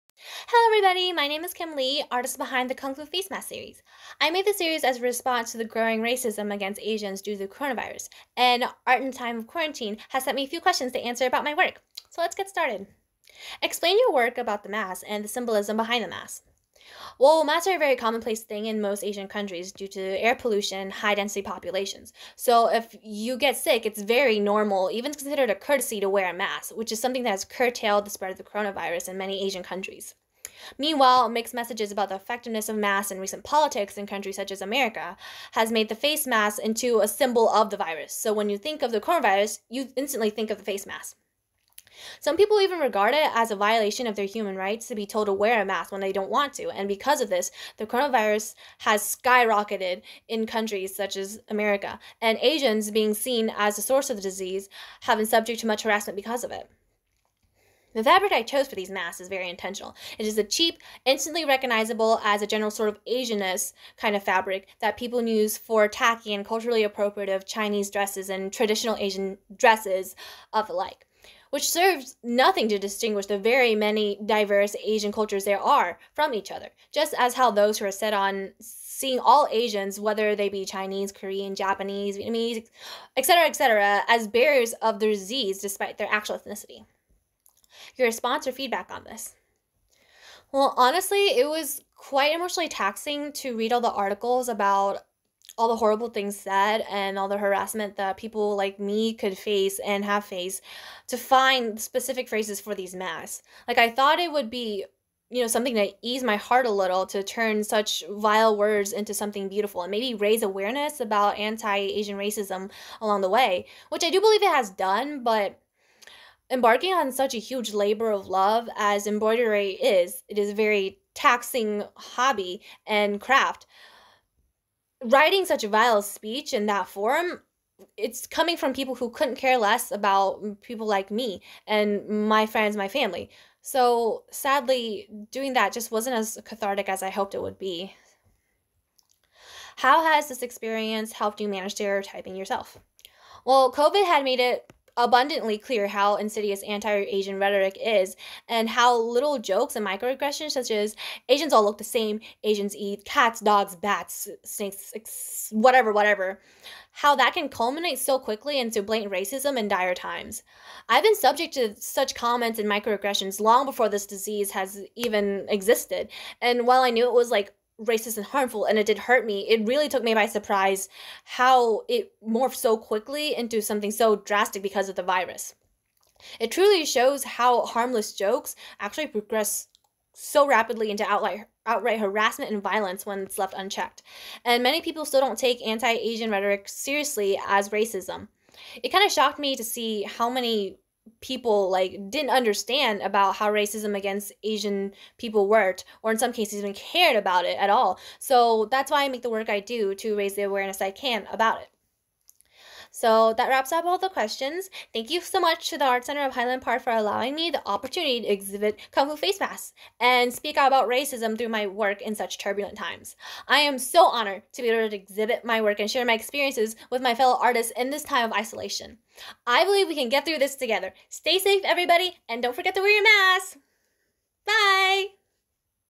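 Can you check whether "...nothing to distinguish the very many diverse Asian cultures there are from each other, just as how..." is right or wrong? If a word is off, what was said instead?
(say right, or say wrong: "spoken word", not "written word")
right.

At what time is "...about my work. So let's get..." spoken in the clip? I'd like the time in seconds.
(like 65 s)
11 s.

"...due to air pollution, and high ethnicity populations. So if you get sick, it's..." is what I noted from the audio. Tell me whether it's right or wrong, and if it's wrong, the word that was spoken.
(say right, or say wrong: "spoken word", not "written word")
wrong: "density", not "ethnicity".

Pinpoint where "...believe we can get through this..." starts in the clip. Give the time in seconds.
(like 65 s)
219 s.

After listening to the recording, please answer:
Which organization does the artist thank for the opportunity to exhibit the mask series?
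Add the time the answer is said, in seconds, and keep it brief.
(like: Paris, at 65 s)
Art Center of Highland Park, at 205 s.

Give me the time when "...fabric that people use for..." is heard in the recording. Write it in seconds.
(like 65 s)
64 s.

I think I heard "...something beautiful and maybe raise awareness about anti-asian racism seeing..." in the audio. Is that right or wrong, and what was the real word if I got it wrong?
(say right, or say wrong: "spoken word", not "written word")
wrong: "along", not "seeing".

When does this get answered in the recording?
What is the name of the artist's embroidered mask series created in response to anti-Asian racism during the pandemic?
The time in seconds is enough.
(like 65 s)
2 s.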